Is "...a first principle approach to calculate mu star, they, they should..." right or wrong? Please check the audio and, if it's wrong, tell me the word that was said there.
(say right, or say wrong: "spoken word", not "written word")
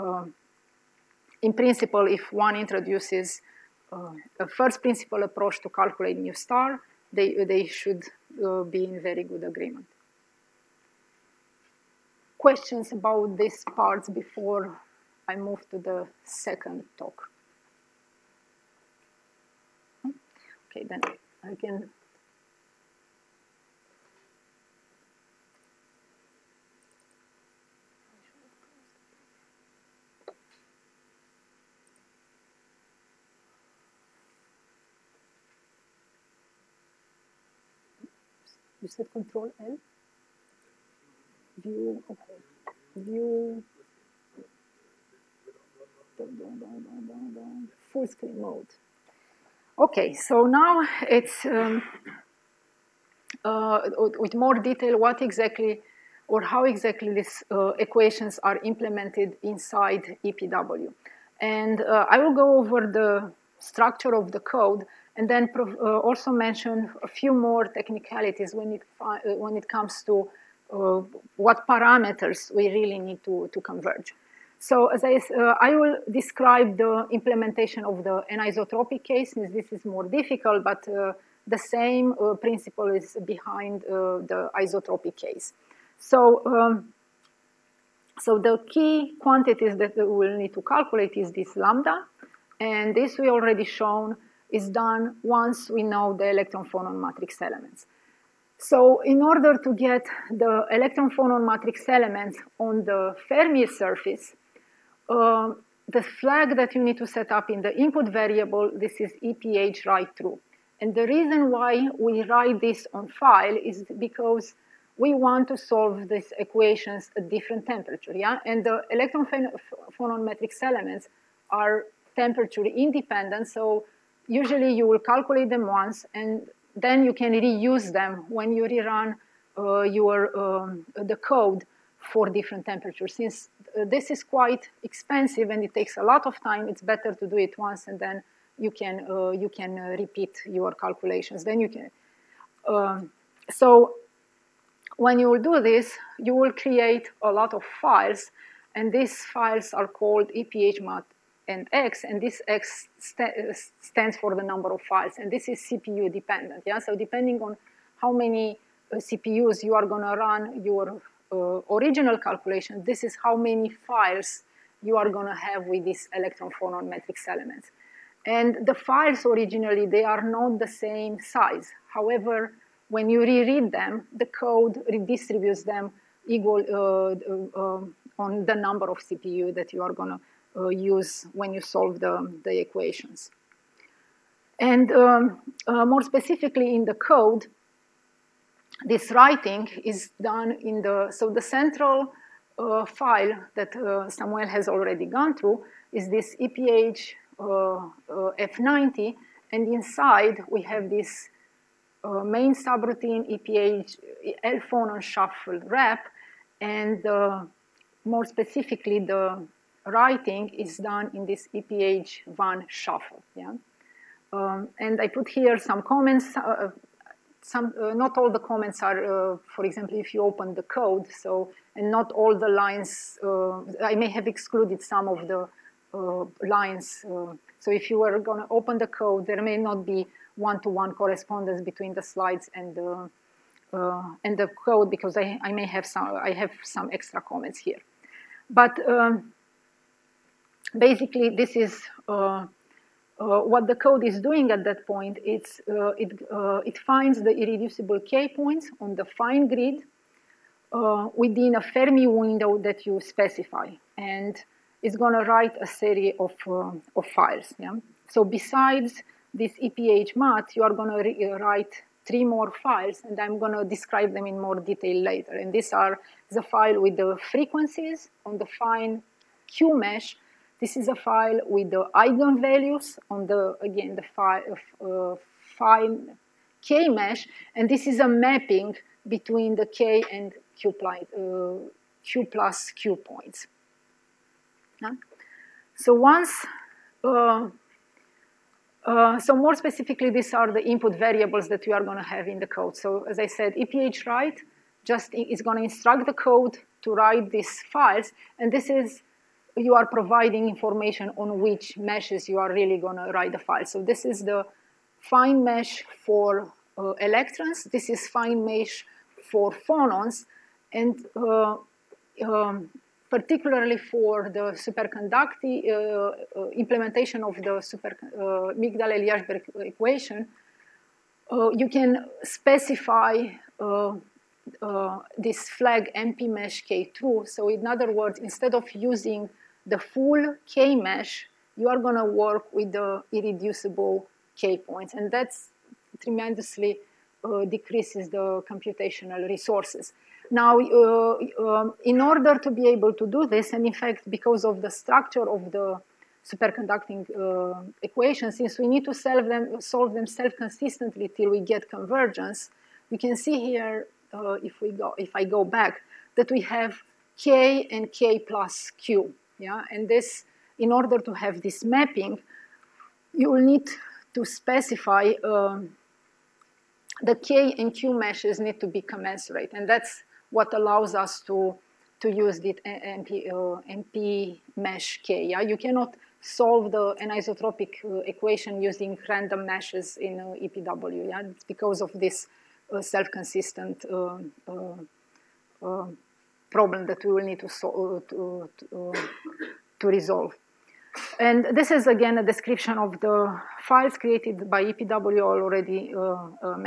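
right.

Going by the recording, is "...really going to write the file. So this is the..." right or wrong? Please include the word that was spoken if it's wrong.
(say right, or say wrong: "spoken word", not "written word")
right.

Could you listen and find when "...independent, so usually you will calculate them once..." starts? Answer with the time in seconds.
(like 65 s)
122 s.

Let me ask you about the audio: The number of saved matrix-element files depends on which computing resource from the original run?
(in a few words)
CPUs.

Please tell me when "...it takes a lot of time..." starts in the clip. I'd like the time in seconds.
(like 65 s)
135 s.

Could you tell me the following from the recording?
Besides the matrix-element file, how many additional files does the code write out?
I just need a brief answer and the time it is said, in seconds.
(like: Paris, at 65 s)
3, at 262 s.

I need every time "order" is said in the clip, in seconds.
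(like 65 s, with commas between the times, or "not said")
99 s, 341 s, 360 s.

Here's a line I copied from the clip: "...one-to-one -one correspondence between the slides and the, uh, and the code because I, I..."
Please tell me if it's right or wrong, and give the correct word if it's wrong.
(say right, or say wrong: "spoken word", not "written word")
right.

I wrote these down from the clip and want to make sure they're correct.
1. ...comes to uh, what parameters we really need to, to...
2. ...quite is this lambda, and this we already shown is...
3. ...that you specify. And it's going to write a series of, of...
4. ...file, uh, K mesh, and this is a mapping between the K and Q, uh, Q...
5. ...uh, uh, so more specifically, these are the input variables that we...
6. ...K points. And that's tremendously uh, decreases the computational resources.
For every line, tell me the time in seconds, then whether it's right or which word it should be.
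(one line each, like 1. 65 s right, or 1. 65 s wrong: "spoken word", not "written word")
1. 69 s right
2. 90 s wrong: "calculate", not "quite"
3. 252 s right
4. 274 s right
5. 287 s right
6. 334 s right.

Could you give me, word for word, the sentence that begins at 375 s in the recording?
Yeah, you cannot solve the anisotropic uh, equation using random meshes in uh, EPW.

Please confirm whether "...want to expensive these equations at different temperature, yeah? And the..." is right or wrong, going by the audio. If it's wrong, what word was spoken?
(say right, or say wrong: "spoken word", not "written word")
wrong: "solve", not "expensive".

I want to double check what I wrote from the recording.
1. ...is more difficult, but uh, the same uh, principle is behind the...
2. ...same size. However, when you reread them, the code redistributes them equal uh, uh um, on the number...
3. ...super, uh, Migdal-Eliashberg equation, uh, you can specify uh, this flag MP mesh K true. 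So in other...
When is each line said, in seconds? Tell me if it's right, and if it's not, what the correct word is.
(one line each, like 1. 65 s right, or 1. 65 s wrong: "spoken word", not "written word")
1. 79 s right
2. 170 s right
3. 317 s right.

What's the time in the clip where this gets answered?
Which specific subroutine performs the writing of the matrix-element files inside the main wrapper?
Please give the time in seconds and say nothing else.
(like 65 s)
211 s.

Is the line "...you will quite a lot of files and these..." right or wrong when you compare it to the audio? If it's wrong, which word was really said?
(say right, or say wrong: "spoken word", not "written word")
wrong: "create", not "quite".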